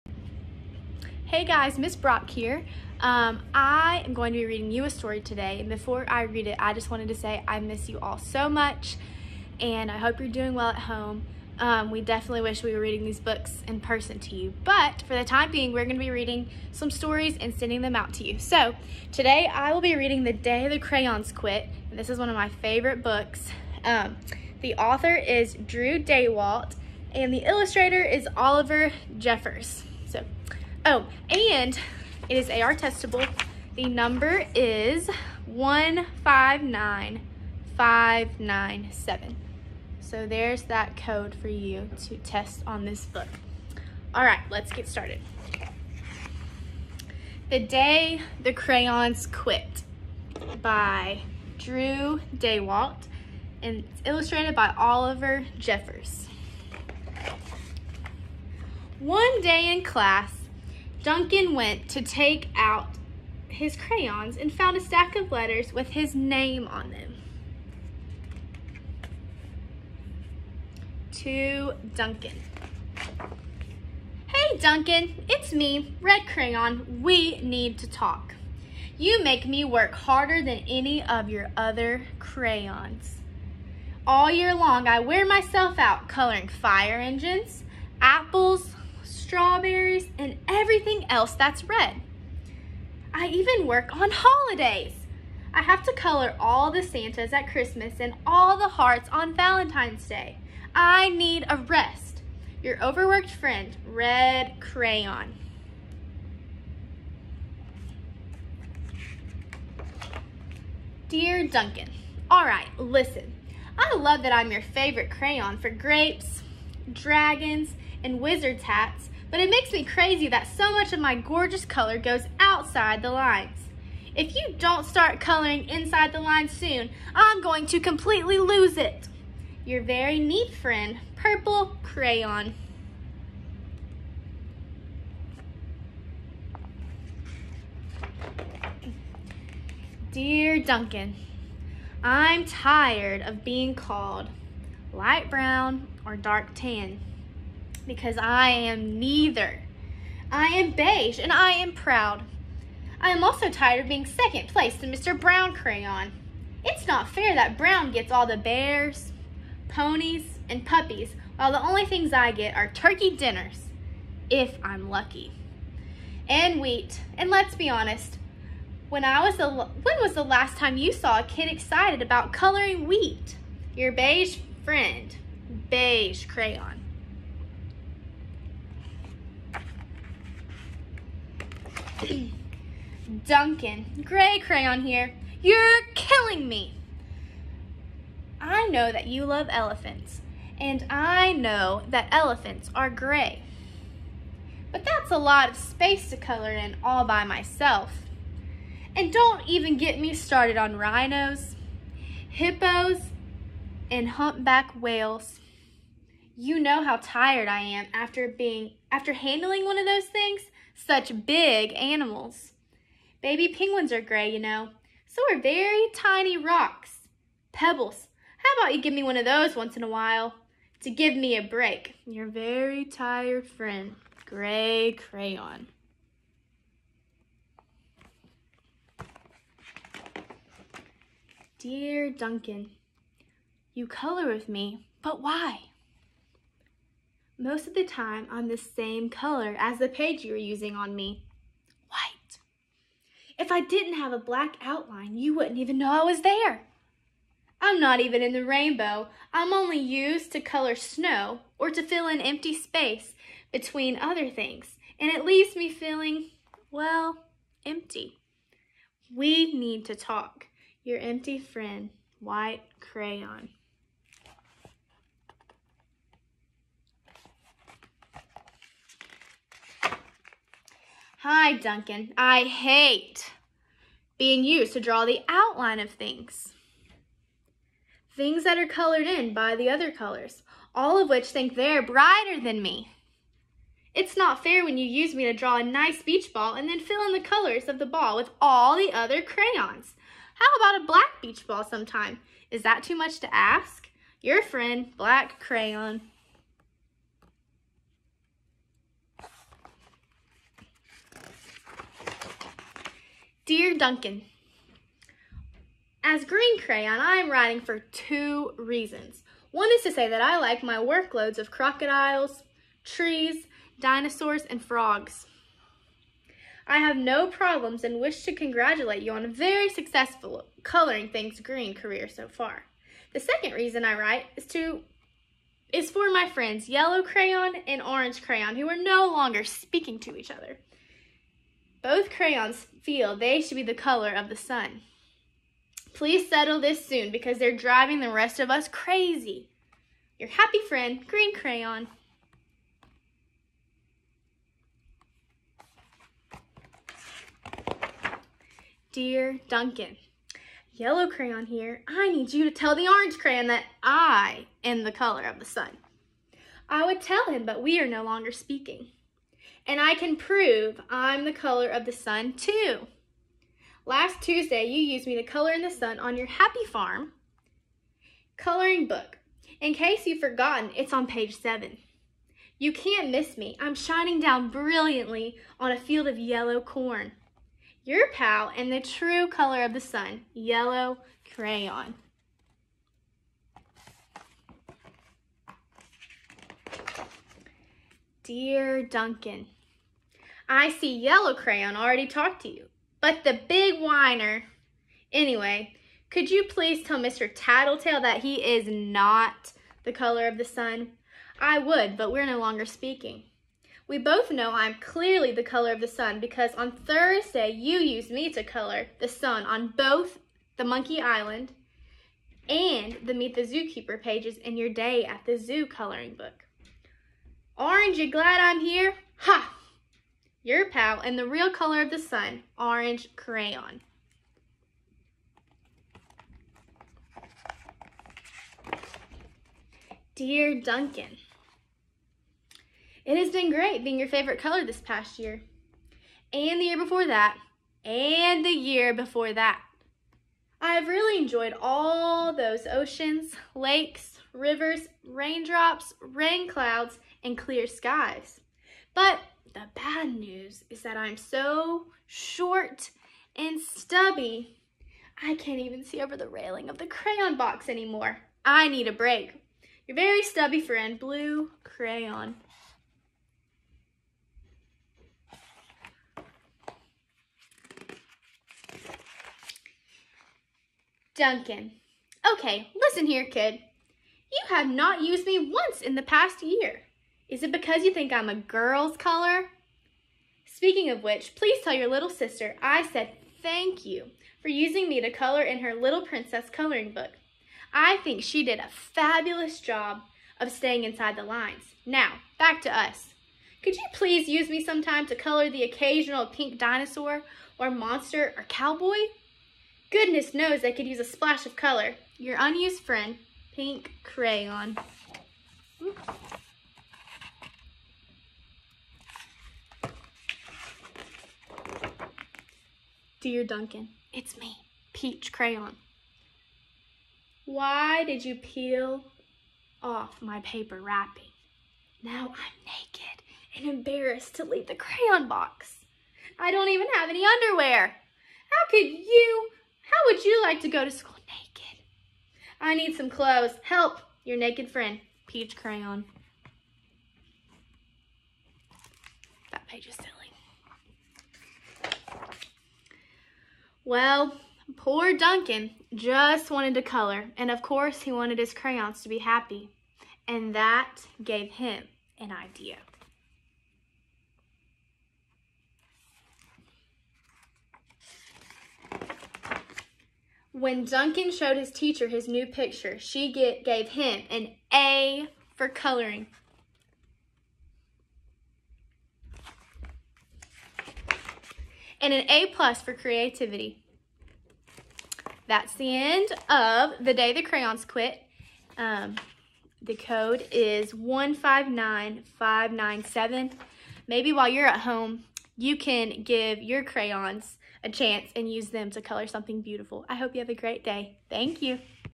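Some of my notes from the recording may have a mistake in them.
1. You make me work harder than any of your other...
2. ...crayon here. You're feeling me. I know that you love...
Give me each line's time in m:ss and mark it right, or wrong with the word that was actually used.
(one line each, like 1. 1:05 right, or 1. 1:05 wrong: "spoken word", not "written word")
1. 1:18 right
2. 3:04 wrong: "killing", not "feeling".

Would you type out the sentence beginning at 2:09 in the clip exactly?
Your very neat friend, Purple Crayon.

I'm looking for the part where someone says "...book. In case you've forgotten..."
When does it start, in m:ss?
6:08.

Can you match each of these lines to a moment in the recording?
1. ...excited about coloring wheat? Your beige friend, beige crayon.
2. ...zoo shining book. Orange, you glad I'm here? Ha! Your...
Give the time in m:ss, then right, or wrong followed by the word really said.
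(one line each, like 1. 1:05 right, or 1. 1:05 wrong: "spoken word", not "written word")
1. 2:51 right
2. 6:55 wrong: "coloring", not "shining".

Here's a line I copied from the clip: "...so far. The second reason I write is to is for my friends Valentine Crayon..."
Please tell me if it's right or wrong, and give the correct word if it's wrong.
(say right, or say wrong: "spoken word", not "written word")
wrong: "Yellow", not "Valentine".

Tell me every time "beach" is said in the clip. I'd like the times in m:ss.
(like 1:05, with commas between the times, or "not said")
4:46, 4:51.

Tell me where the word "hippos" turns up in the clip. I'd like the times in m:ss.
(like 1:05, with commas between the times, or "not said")
3:22.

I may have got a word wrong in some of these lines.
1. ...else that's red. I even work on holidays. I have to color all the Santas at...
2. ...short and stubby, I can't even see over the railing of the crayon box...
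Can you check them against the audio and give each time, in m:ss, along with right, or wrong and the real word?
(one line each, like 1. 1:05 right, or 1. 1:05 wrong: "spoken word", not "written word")
1. 1:31 right
2. 7:32 right.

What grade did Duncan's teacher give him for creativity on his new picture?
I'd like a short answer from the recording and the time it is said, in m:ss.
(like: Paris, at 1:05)
A plus, at 9:32.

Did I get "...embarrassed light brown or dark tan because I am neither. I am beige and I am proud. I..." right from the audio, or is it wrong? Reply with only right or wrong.
wrong.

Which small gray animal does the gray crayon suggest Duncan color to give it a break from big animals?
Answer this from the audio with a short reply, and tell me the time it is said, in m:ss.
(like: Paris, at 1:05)
Baby penguins, at 3:33.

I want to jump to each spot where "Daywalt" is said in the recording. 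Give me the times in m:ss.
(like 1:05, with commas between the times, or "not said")
0:25, 0:52.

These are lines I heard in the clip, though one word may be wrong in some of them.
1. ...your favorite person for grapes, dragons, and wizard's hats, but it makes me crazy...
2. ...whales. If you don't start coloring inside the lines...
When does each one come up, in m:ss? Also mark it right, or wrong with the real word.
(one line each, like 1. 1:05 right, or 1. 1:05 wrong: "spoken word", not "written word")
1. 1:54 wrong: "crayon", not "person"
2. 2:03 wrong: "lines", not "whales".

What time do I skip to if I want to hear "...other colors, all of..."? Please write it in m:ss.
4:39.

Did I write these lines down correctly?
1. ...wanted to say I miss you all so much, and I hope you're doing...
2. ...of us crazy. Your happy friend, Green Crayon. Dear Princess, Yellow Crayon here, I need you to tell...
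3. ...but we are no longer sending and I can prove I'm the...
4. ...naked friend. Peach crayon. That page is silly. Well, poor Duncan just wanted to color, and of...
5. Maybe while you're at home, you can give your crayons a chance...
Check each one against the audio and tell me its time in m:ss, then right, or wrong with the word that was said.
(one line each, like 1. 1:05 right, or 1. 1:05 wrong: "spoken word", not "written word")
1. 0:06 right
2. 5:38 wrong: "Duncan", not "Princess"
3. 5:57 wrong: "speaking", not "sending"
4. 8:54 right
5. 9:44 right.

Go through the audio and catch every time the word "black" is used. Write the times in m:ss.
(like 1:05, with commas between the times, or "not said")
4:04, 4:50, 4:54.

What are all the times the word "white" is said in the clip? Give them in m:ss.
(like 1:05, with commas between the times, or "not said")
4:01, 4:22.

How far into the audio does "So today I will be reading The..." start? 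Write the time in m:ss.
0:18.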